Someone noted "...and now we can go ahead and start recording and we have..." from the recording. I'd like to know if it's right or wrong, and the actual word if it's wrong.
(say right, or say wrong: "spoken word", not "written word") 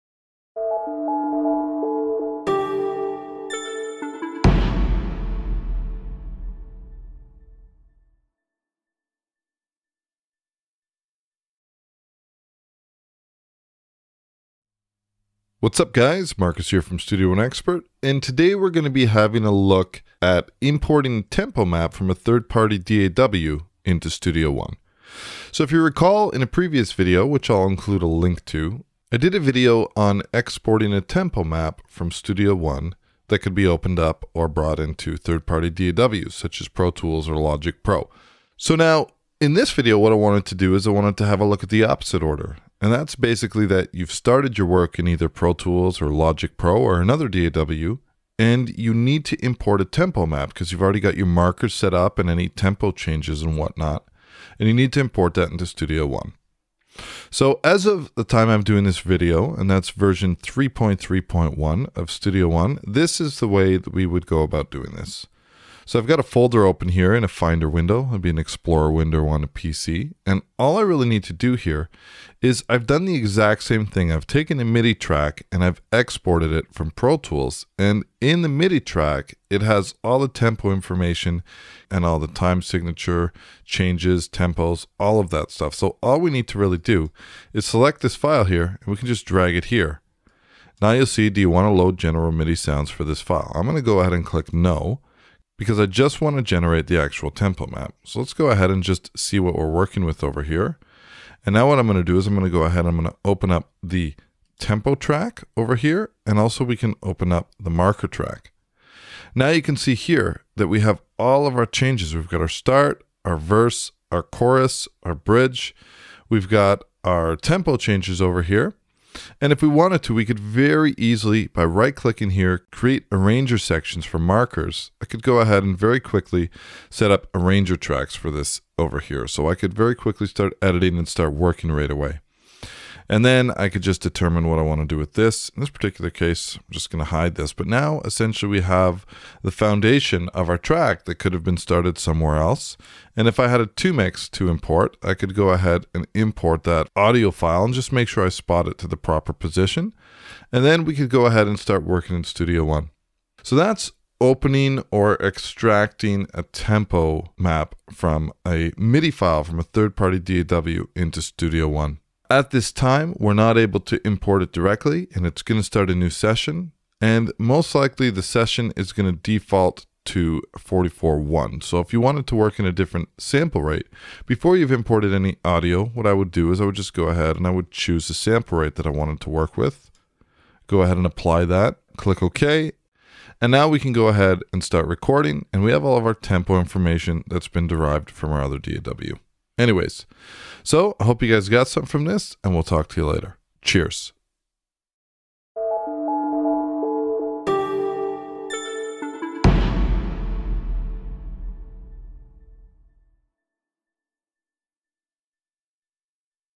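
right.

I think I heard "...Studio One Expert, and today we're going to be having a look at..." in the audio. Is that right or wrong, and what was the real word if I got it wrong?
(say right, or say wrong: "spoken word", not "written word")
right.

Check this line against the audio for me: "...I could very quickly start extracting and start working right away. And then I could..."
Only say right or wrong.
wrong.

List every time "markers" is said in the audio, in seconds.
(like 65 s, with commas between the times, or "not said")
51 s, 107 s, 124 s.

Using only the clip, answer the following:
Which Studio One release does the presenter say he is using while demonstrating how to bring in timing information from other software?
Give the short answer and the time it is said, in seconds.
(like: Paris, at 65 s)
3.3.1, at 60 s.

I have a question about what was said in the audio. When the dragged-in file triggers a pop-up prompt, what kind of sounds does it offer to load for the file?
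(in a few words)
General MIDI sounds.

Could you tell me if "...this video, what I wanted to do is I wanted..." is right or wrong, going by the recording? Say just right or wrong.
right.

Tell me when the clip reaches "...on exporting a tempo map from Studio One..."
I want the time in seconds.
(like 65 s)
29 s.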